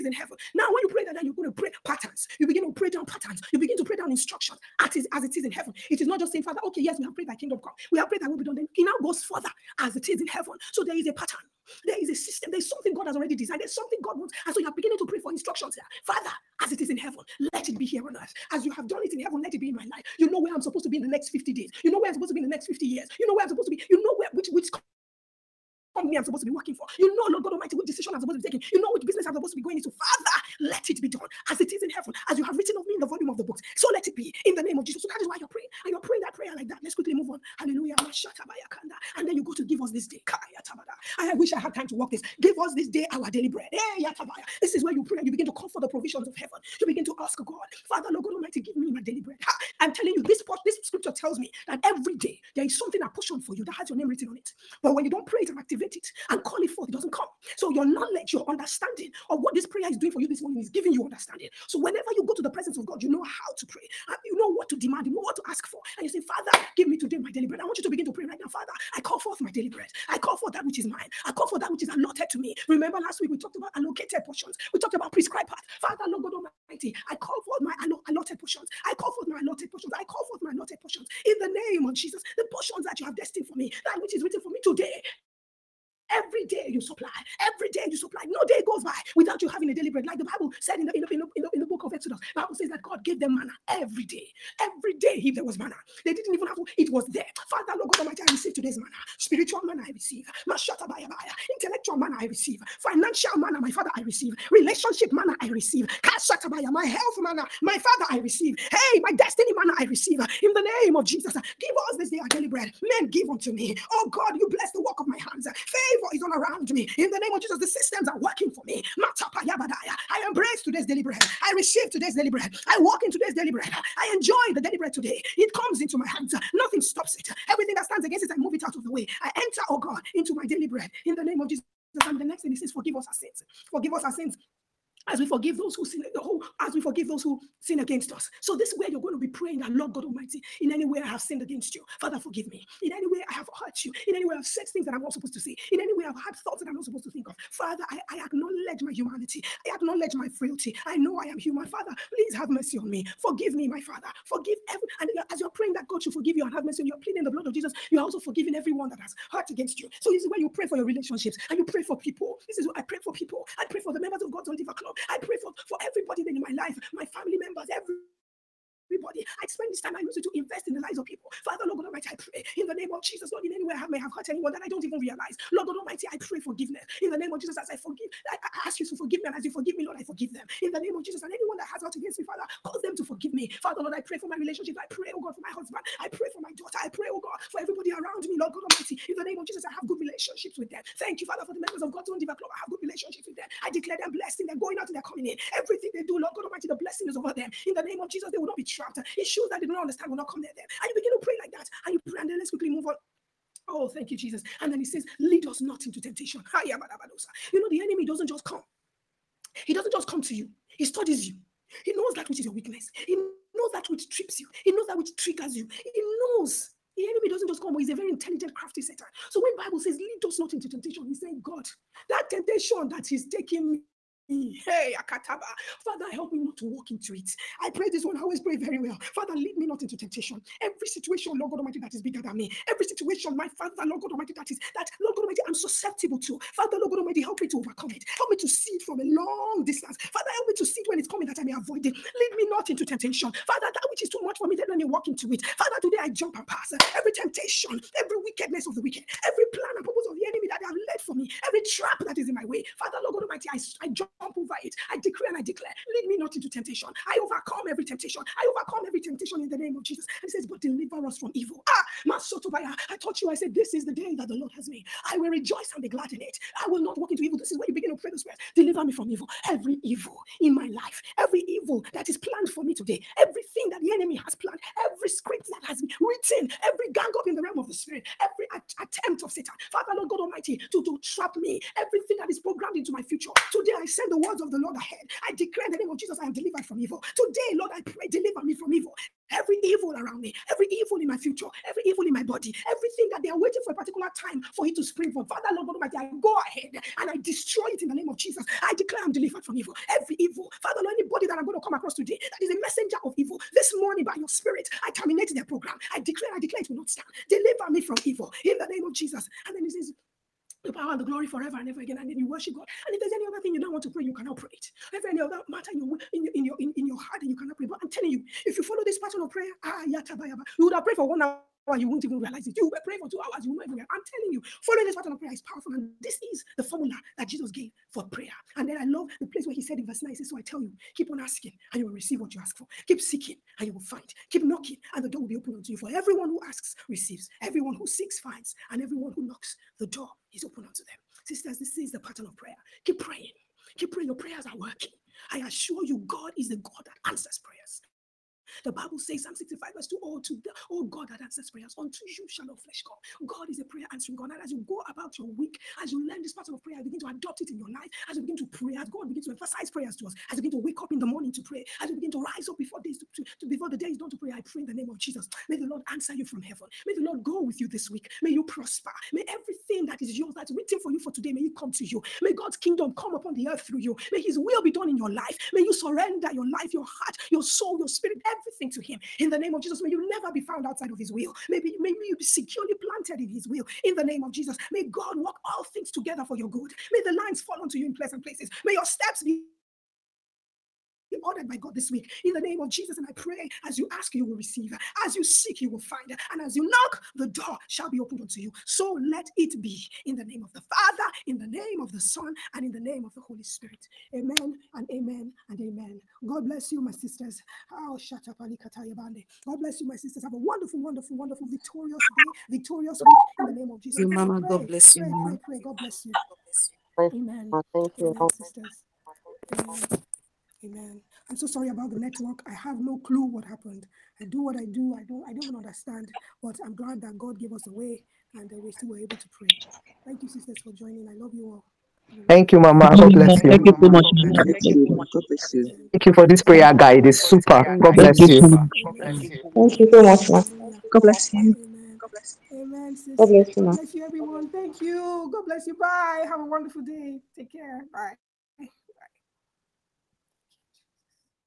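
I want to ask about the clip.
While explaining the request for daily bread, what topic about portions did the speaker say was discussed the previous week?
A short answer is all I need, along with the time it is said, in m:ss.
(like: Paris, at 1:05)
allocated portions, at 1:13.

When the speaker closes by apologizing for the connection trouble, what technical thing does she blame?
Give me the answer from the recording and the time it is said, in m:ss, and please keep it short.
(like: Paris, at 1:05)
the network, at 7:01.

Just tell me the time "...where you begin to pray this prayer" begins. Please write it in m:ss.
4:27.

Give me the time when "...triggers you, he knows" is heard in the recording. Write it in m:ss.
3:35.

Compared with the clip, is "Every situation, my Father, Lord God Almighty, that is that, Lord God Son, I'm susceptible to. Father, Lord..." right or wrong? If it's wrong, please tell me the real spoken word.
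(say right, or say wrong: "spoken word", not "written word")
wrong: "Almighty", not "Son".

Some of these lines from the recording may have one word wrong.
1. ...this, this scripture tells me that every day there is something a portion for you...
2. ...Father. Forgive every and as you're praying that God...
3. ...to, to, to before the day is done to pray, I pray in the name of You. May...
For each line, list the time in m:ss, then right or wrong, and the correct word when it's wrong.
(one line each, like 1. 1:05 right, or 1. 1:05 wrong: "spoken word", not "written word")
1. 0:50 right
2. 2:33 right
3. 6:02 wrong: "Jesus", not "You".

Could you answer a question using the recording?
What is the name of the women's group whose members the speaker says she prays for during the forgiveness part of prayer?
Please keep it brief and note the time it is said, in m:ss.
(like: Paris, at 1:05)
God's Diva Club, at 2:44.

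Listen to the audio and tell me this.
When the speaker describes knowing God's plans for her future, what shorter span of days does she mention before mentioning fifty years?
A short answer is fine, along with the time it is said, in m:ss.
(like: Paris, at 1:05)
50 days, at 0:21.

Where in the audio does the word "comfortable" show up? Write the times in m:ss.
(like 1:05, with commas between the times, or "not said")
not said.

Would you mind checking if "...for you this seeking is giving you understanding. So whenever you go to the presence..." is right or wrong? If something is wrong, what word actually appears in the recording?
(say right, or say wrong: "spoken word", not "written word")
wrong: "morning", not "seeking".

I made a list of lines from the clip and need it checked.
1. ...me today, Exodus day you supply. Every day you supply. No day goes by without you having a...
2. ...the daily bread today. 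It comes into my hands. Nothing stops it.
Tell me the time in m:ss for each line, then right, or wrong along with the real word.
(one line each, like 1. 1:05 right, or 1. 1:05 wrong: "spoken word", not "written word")
1. 1:24 wrong: "Every", not "Exodus"
2. 2:04 right.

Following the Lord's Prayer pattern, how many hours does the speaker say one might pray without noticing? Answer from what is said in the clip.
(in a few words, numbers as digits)
2 hours.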